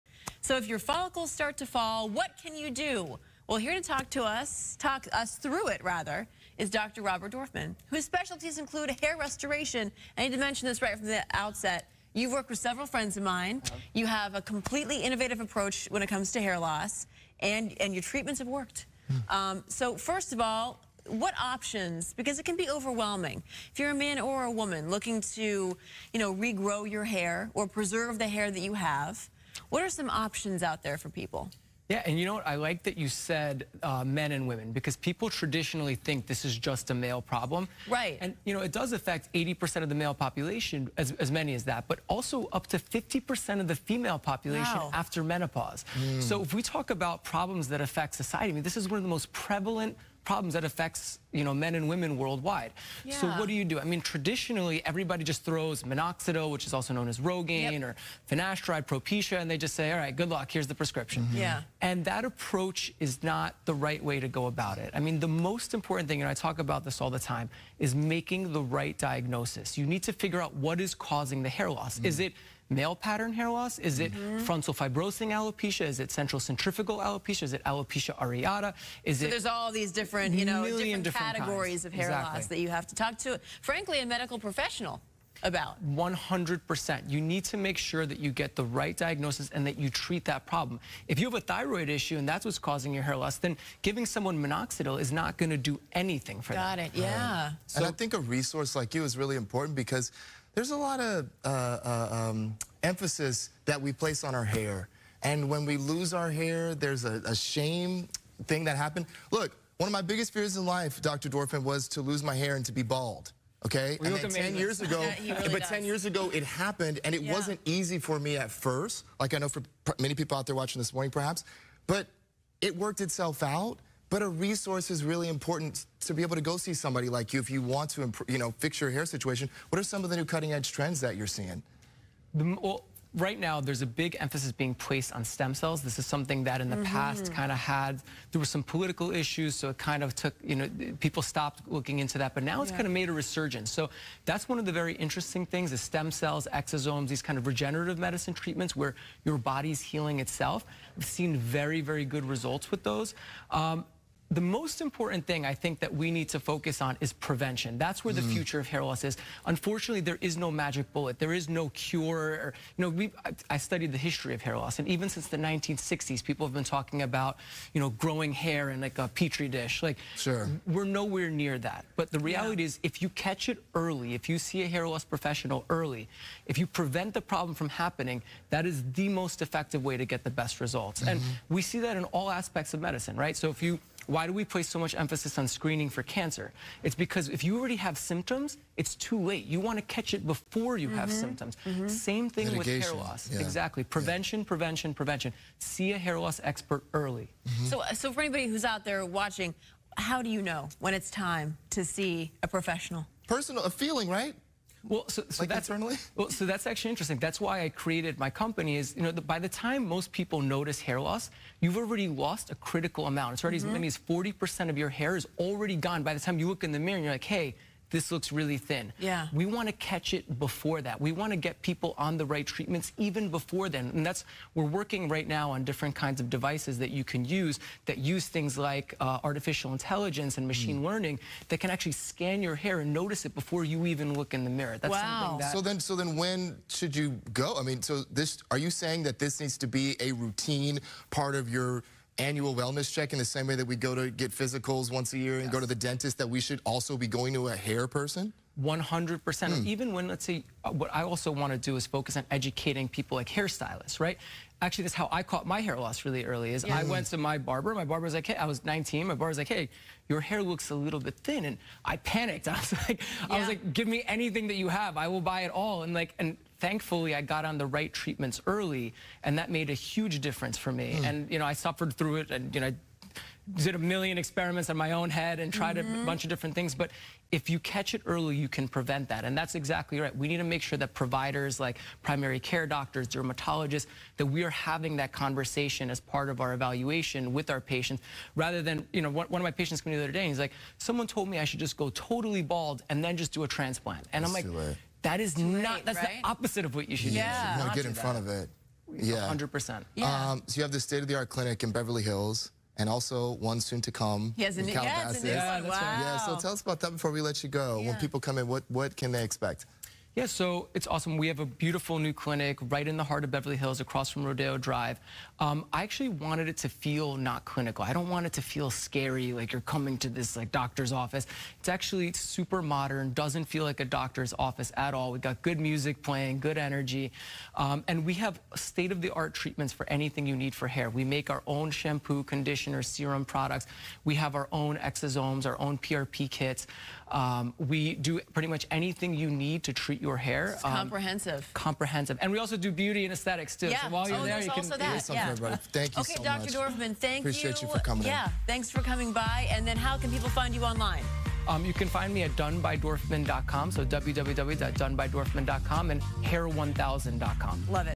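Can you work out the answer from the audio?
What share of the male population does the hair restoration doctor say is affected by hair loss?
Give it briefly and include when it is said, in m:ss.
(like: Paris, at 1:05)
80%, at 0:39.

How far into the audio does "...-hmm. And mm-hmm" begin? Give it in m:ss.
3:01.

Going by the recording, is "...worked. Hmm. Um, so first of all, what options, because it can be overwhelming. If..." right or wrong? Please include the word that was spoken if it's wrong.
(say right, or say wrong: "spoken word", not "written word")
right.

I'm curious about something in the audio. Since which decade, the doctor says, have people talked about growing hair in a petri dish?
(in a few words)
1960s.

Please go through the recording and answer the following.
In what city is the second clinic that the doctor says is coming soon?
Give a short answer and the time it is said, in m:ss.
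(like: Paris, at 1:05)
Calabasas, at 5:04.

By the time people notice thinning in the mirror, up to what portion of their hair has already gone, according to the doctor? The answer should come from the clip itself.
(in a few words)
40%.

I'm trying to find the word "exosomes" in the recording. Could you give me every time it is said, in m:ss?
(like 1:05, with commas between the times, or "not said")
2:26, 5:34.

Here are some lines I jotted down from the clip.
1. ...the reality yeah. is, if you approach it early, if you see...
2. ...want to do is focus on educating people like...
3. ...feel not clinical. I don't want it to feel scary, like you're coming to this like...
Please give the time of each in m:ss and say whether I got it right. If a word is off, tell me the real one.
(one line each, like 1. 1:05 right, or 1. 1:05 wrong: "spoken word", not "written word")
1. 2:52 wrong: "catch", not "approach"
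2. 4:11 right
3. 5:16 right.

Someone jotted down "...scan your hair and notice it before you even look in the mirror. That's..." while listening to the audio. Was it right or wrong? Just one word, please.
right.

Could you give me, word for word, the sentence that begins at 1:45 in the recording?
And when we lose our hair, there's a, a shame thing that happened.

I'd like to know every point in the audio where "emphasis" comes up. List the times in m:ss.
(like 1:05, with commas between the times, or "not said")
1:42, 2:14, 3:04.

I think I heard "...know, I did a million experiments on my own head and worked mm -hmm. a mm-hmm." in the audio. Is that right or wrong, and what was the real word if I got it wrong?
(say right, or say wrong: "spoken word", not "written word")
wrong: "tried", not "worked".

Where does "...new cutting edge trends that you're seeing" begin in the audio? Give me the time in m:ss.
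2:10.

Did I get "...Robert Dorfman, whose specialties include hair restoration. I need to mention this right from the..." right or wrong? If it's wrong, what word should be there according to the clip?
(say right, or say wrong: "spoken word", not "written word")
right.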